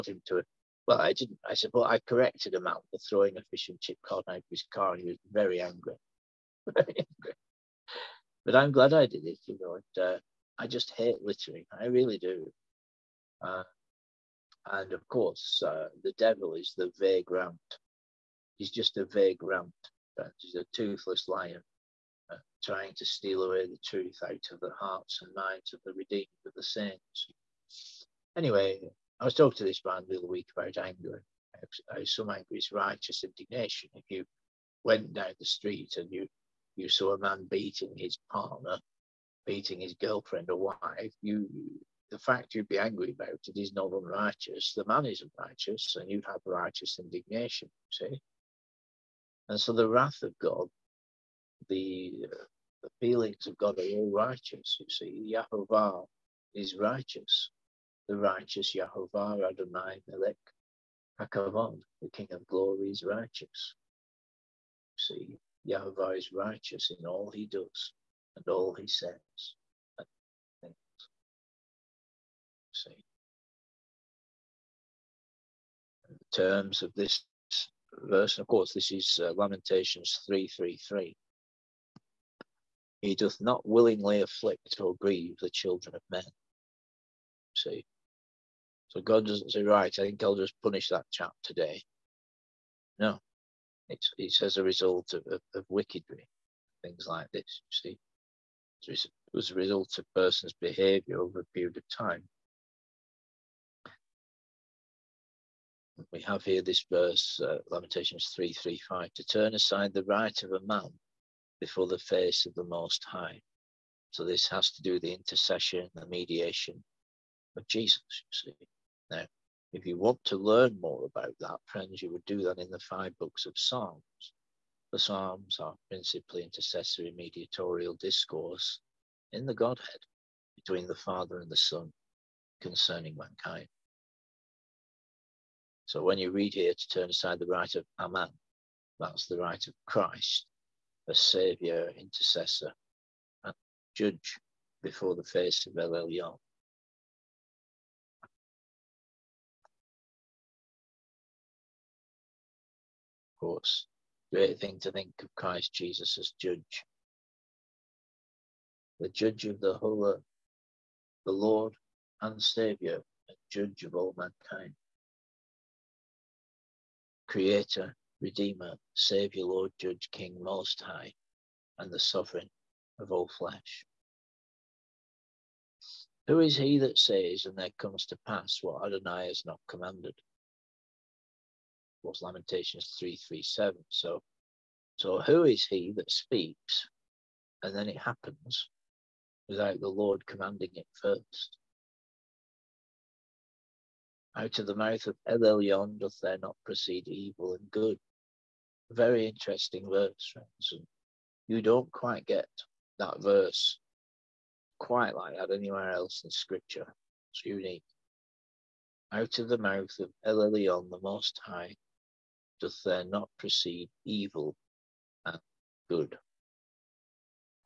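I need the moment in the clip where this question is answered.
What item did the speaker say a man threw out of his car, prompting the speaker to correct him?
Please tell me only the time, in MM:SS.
00:03.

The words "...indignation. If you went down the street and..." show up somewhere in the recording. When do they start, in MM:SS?
00:33.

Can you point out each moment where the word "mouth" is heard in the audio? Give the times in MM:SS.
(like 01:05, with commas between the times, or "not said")
03:14, 03:29.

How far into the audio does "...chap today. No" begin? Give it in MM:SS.
01:31.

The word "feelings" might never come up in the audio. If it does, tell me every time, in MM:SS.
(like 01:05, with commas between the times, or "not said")
00:53.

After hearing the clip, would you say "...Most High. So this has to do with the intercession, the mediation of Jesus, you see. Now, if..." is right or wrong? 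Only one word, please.
right.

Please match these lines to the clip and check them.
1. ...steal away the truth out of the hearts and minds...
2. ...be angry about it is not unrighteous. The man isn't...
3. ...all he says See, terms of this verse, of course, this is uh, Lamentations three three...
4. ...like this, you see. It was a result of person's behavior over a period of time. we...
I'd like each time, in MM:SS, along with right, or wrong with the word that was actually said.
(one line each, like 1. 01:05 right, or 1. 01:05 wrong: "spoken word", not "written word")
1. 00:23 right
2. 00:42 right
3. 01:08 right
4. 01:37 right.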